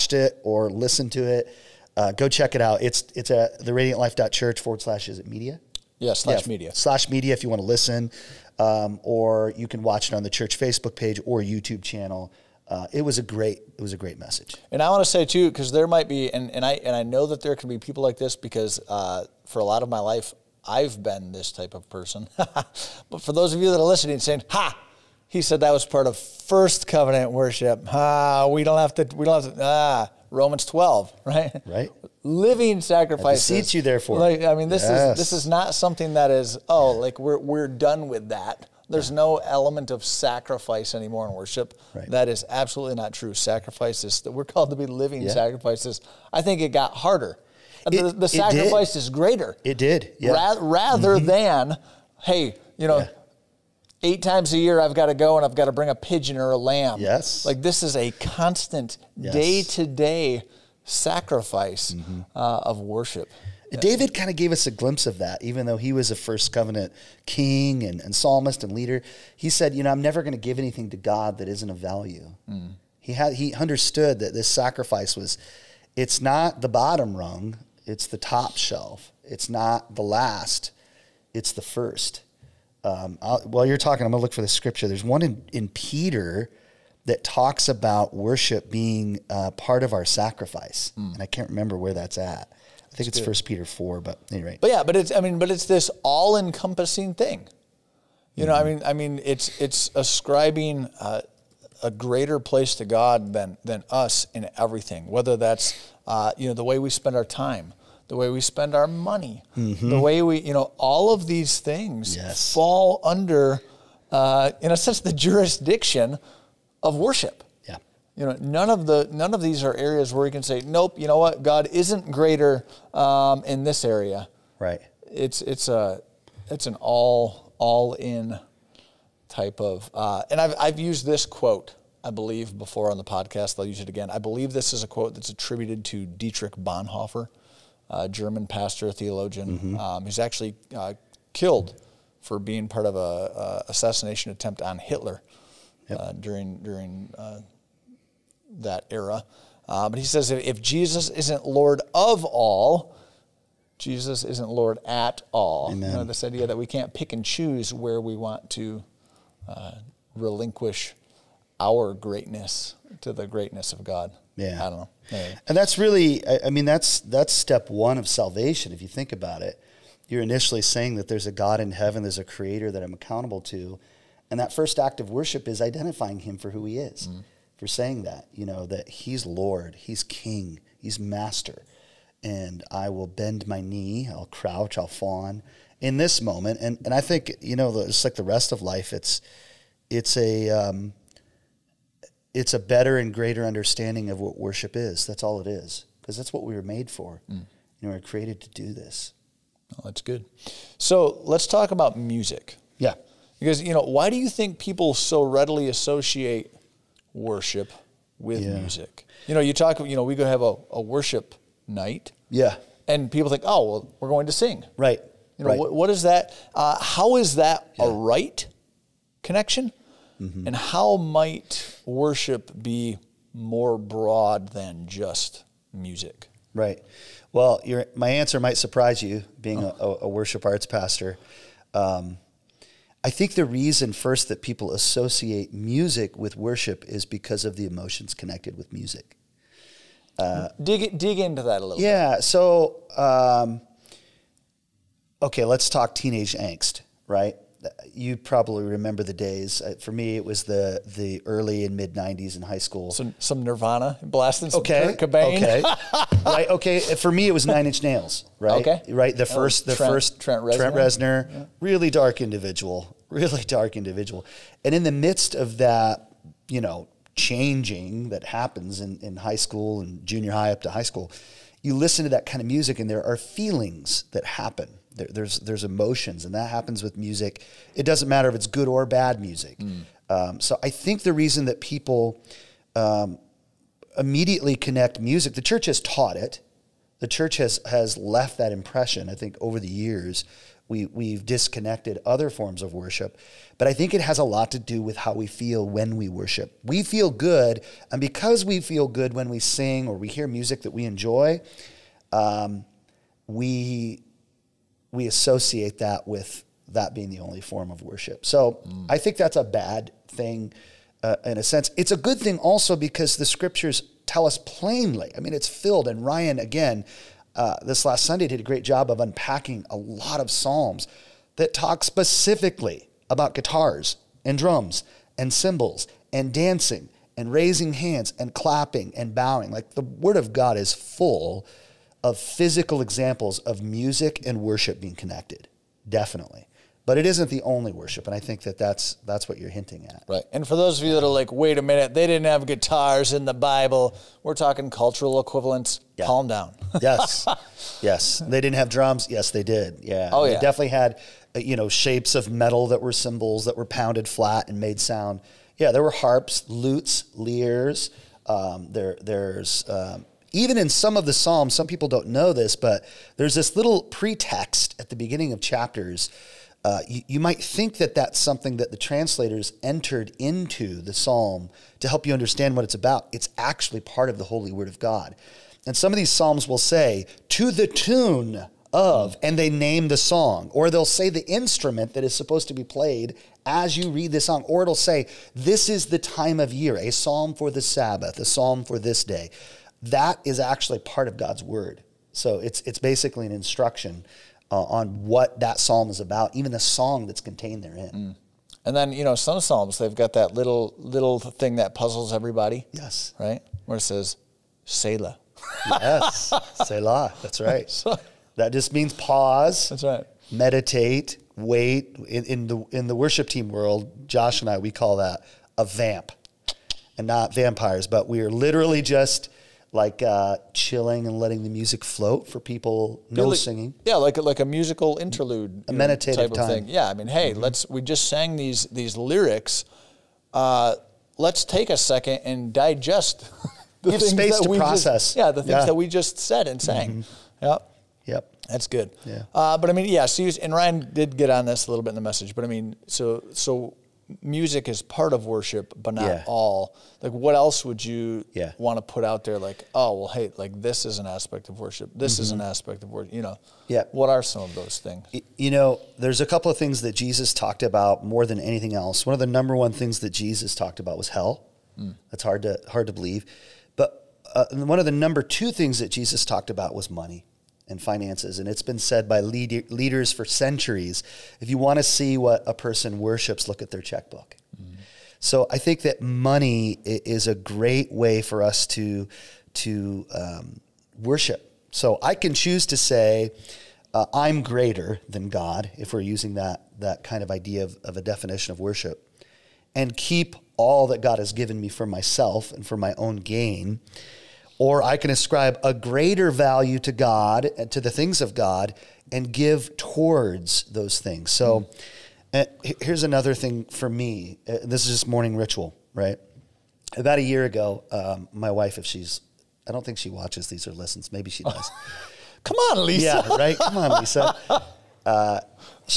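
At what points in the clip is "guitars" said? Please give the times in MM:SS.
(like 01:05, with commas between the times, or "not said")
05:23, 05:42.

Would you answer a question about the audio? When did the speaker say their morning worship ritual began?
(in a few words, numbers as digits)
About a year ago.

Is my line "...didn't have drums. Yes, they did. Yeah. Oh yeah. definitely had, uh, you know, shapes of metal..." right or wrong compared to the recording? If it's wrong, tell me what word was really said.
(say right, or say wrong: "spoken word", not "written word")
right.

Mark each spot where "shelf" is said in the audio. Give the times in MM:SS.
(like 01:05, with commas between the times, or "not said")
01:18.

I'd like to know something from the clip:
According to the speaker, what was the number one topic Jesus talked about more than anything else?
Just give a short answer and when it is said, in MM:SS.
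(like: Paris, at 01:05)
Hell, at 07:41.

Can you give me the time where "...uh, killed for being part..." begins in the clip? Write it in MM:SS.
02:20.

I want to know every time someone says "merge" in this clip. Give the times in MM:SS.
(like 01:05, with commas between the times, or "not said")
not said.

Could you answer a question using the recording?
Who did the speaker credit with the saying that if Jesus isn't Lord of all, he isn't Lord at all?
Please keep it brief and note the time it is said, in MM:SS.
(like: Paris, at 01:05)
Dietrich Bonhoeffer, at 02:16.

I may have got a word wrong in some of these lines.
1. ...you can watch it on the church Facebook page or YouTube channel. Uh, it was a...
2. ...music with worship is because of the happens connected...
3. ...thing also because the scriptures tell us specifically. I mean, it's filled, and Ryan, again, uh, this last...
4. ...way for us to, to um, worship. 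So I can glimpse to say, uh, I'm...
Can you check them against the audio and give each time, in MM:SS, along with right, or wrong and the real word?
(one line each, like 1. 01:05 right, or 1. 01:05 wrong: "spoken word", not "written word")
1. 00:09 right
2. 03:55 wrong: "emotions", not "happens"
3. 05:12 wrong: "plainly", not "specifically"
4. 07:57 wrong: "choose", not "glimpse".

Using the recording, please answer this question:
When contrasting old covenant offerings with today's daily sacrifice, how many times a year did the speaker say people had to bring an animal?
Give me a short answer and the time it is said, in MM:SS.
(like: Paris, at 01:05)
8, at 00:54.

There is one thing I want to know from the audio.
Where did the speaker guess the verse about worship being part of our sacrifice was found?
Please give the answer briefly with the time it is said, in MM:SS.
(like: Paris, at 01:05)
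Peter 4, at 01:33.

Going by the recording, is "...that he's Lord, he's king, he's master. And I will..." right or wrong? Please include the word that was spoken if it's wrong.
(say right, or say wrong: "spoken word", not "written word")
right.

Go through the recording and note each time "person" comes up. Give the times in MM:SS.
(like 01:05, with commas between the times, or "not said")
00:21, 07:52.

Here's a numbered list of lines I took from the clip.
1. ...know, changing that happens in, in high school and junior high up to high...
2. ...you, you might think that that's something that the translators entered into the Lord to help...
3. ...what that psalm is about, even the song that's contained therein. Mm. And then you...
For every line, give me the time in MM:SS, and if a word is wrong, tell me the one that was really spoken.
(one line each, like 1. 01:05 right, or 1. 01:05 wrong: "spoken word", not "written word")
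1. 04:26 right
2. 06:06 wrong: "Psalm", not "Lord"
3. 06:35 right.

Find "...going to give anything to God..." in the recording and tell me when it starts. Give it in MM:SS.
01:10.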